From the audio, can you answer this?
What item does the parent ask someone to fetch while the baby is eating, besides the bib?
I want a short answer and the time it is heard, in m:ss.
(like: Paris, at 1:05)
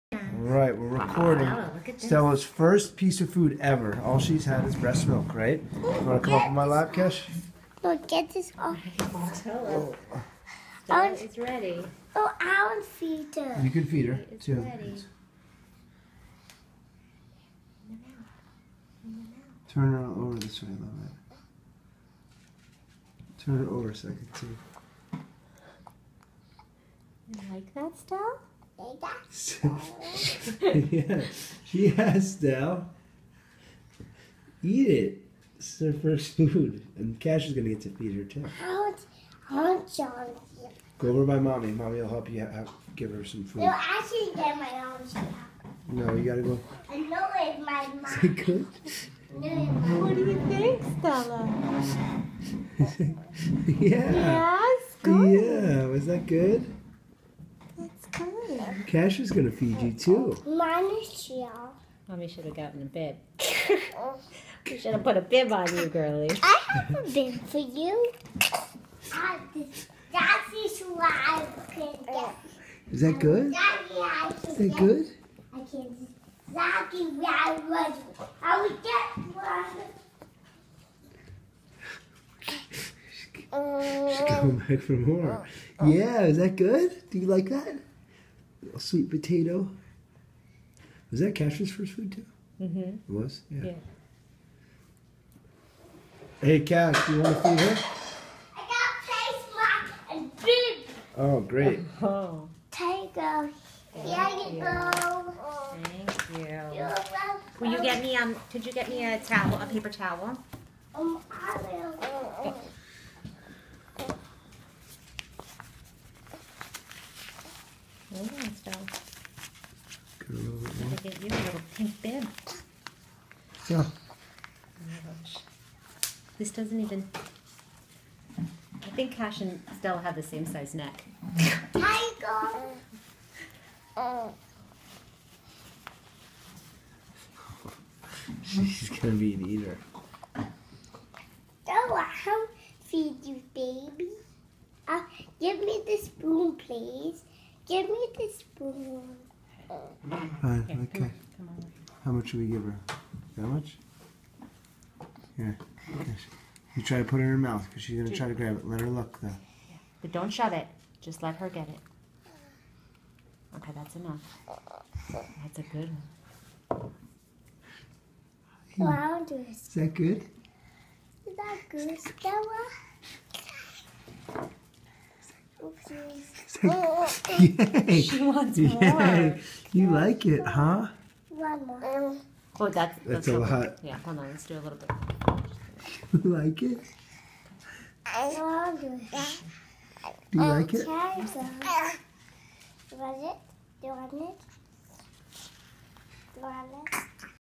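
a paper towel, at 1:49.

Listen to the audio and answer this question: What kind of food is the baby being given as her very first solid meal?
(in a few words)
sweet potato.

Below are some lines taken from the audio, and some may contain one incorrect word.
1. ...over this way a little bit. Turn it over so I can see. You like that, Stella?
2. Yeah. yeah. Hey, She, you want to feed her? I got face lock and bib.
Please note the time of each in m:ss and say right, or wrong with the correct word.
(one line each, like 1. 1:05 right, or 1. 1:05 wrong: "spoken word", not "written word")
1. 0:20 right
2. 1:33 wrong: "Cash", not "She".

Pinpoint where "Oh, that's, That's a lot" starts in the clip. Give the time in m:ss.
3:02.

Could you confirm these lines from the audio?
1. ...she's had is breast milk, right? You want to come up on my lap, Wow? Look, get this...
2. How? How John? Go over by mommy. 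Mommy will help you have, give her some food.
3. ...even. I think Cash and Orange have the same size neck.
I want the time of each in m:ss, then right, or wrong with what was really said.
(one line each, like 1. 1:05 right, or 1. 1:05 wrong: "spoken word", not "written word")
1. 0:04 wrong: "Cash", not "Wow"
2. 0:38 right
3. 2:06 wrong: "Stella", not "Orange".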